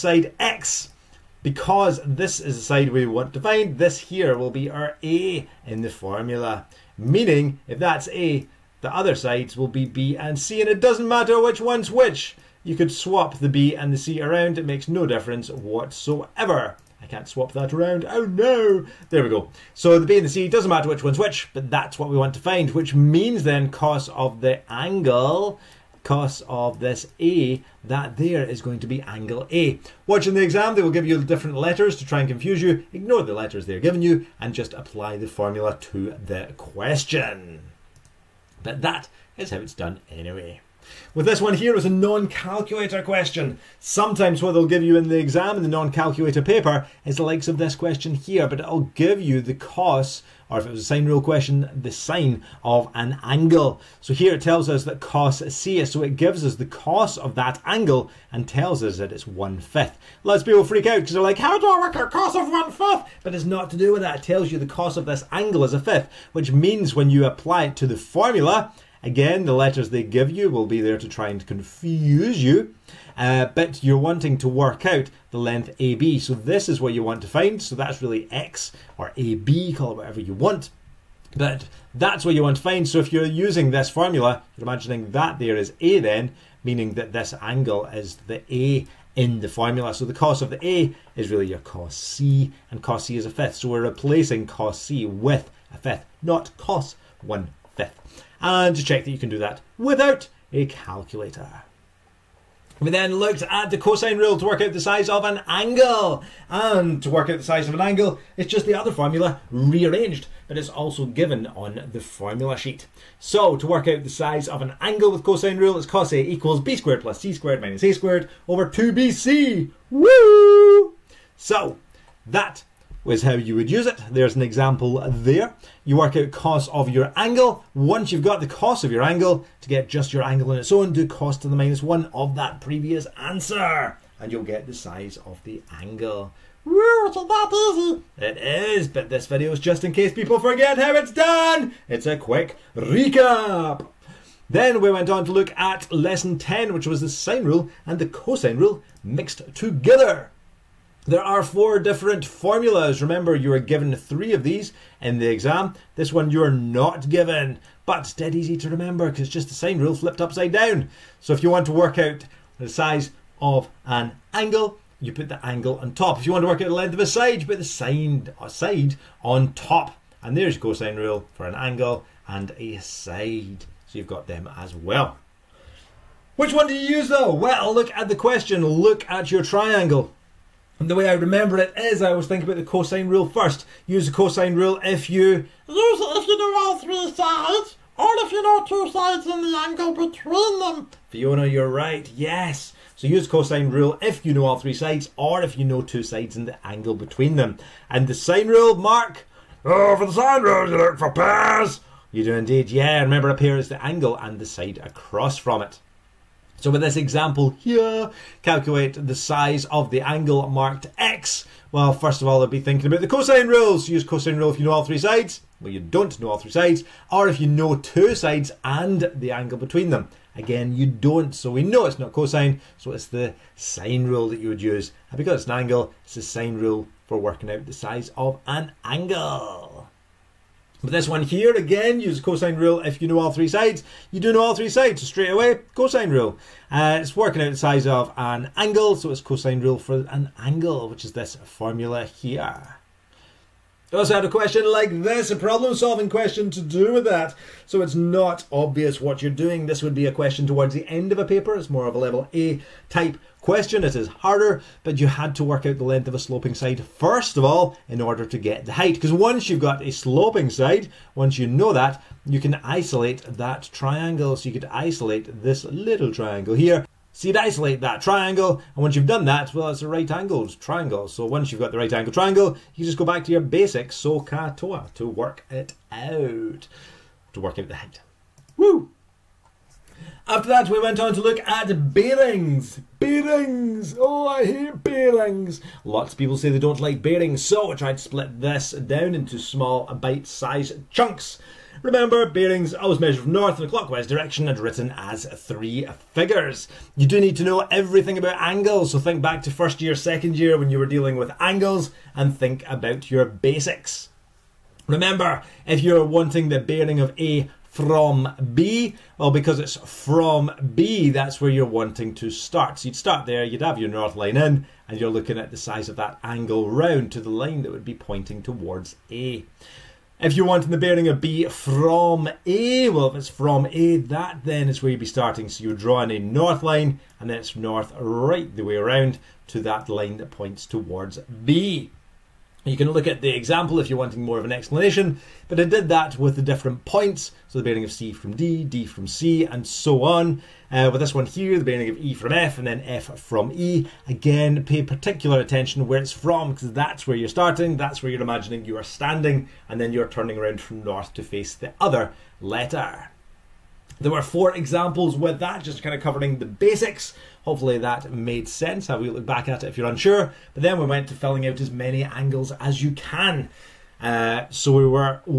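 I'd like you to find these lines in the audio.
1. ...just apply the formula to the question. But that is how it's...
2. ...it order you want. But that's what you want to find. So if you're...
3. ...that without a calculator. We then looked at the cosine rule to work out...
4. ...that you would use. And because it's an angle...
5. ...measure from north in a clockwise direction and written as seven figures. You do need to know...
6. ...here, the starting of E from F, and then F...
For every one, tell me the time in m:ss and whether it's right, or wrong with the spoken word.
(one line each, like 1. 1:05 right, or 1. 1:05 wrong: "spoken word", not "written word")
1. 0:34 right
2. 1:19 wrong: "whatever", not "order"
3. 1:39 right
4. 3:44 right
5. 4:52 wrong: "three", not "seven"
6. 5:41 wrong: "bearing", not "starting".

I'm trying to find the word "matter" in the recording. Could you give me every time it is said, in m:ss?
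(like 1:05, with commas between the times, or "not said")
0:11, 0:20.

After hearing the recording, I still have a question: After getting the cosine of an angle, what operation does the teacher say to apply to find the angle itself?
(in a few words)
cos to the minus one.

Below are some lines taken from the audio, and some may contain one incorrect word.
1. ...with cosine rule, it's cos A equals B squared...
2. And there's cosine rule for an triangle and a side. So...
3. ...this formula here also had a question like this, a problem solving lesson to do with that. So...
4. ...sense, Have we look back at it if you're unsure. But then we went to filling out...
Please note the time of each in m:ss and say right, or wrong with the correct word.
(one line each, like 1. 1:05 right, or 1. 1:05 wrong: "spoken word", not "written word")
1. 1:55 right
2. 2:50 wrong: "angle", not "triangle"
3. 4:01 wrong: "question", not "lesson"
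4. 5:58 right.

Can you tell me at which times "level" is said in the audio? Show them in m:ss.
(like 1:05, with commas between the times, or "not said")
4:11.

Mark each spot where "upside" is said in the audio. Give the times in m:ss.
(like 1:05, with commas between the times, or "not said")
2:40.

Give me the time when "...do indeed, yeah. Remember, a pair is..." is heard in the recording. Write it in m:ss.
3:22.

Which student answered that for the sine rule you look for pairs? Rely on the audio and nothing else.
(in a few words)
Mark.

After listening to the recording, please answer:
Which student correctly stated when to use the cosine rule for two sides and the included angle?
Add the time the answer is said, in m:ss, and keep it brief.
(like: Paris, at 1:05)
Fiona, at 3:11.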